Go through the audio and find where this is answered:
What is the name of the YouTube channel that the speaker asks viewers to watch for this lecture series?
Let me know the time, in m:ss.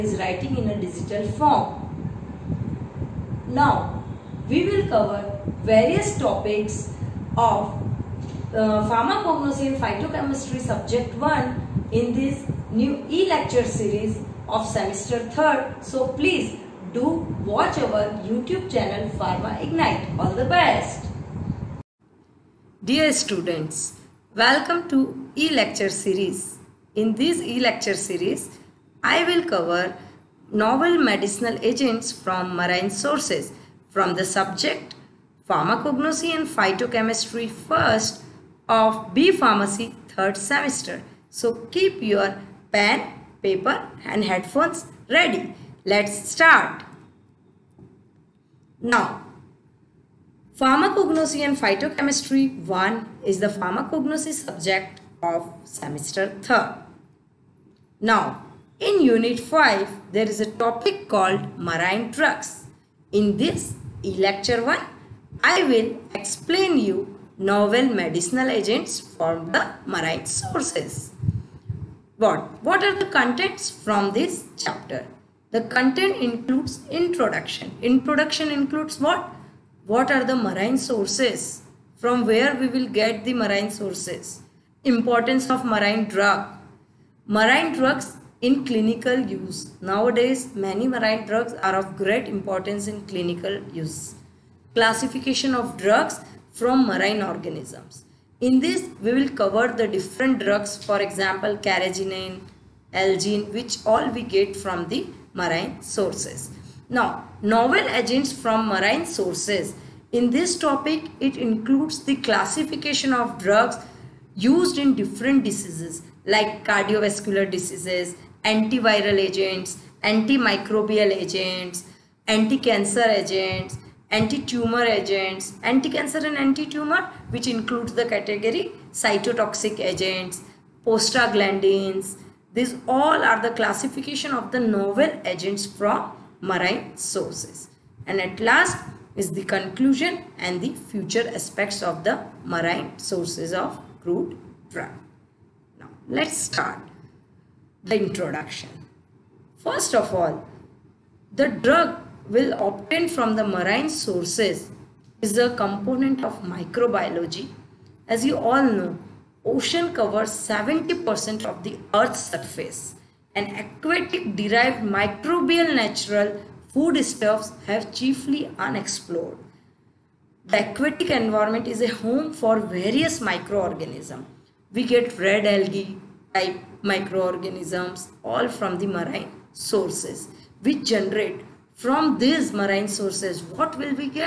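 0:19.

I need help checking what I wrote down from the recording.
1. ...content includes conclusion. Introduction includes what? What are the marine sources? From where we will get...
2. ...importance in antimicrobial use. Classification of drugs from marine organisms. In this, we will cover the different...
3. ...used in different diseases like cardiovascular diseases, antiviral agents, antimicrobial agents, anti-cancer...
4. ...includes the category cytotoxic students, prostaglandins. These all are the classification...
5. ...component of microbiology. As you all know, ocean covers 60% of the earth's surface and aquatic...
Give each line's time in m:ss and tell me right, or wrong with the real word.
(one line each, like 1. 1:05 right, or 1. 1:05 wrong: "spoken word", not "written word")
1. 1:15 wrong: "introduction", not "conclusion"
2. 1:32 wrong: "clinical", not "antimicrobial"
3. 1:54 right
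4. 2:07 wrong: "agents", not "students"
5. 2:35 wrong: "70", not "60".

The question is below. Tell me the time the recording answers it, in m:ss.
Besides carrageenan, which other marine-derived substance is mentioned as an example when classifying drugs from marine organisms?
1:42.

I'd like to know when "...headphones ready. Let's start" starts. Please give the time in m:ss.
0:44.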